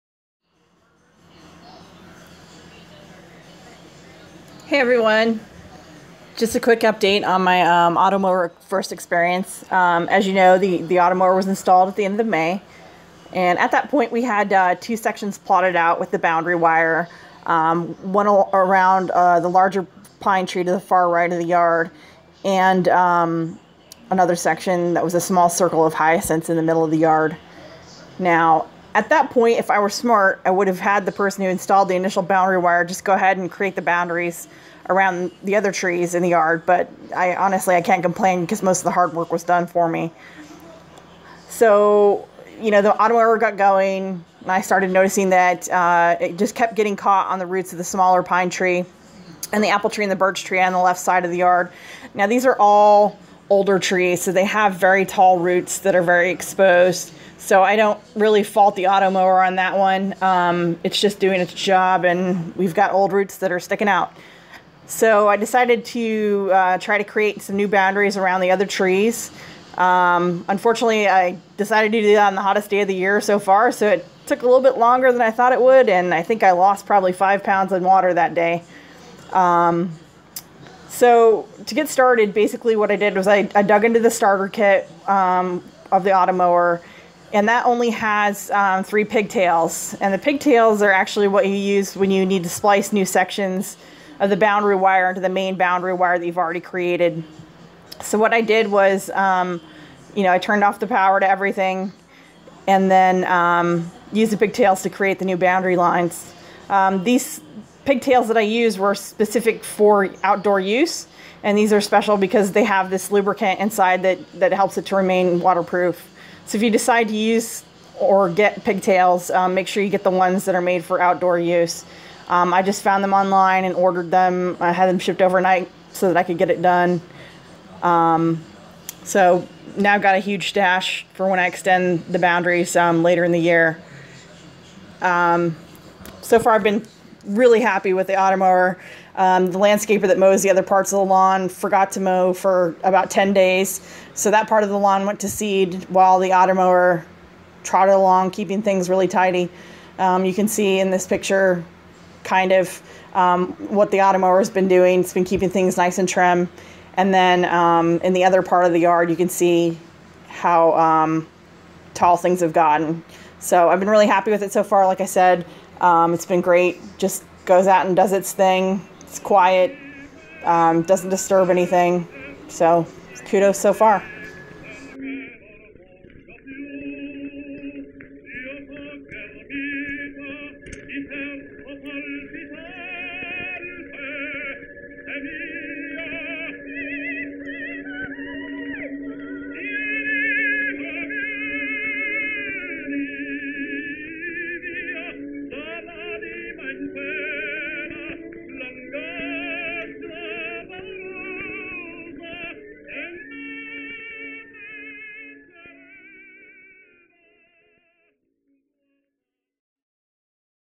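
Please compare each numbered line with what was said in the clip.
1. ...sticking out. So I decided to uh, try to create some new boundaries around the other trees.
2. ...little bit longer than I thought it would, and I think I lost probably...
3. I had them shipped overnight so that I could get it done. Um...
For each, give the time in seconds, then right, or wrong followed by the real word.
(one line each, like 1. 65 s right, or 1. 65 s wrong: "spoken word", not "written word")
1. 63 s right
2. 74 s right
3. 124 s right.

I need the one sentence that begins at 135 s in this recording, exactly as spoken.
Um, so far, I've been really happy with the automower.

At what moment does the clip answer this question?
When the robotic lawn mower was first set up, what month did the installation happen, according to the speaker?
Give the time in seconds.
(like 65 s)
12 s.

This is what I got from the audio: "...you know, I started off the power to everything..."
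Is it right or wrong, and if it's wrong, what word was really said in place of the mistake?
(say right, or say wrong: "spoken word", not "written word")
wrong: "turned", not "started".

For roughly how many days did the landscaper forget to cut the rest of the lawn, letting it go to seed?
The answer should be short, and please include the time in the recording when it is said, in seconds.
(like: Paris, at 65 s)
10, at 143 s.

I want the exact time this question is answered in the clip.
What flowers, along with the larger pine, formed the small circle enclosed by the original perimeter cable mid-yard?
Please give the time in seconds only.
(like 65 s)
25 s.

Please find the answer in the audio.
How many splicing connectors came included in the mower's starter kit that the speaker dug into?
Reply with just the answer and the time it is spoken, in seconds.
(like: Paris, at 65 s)
3, at 88 s.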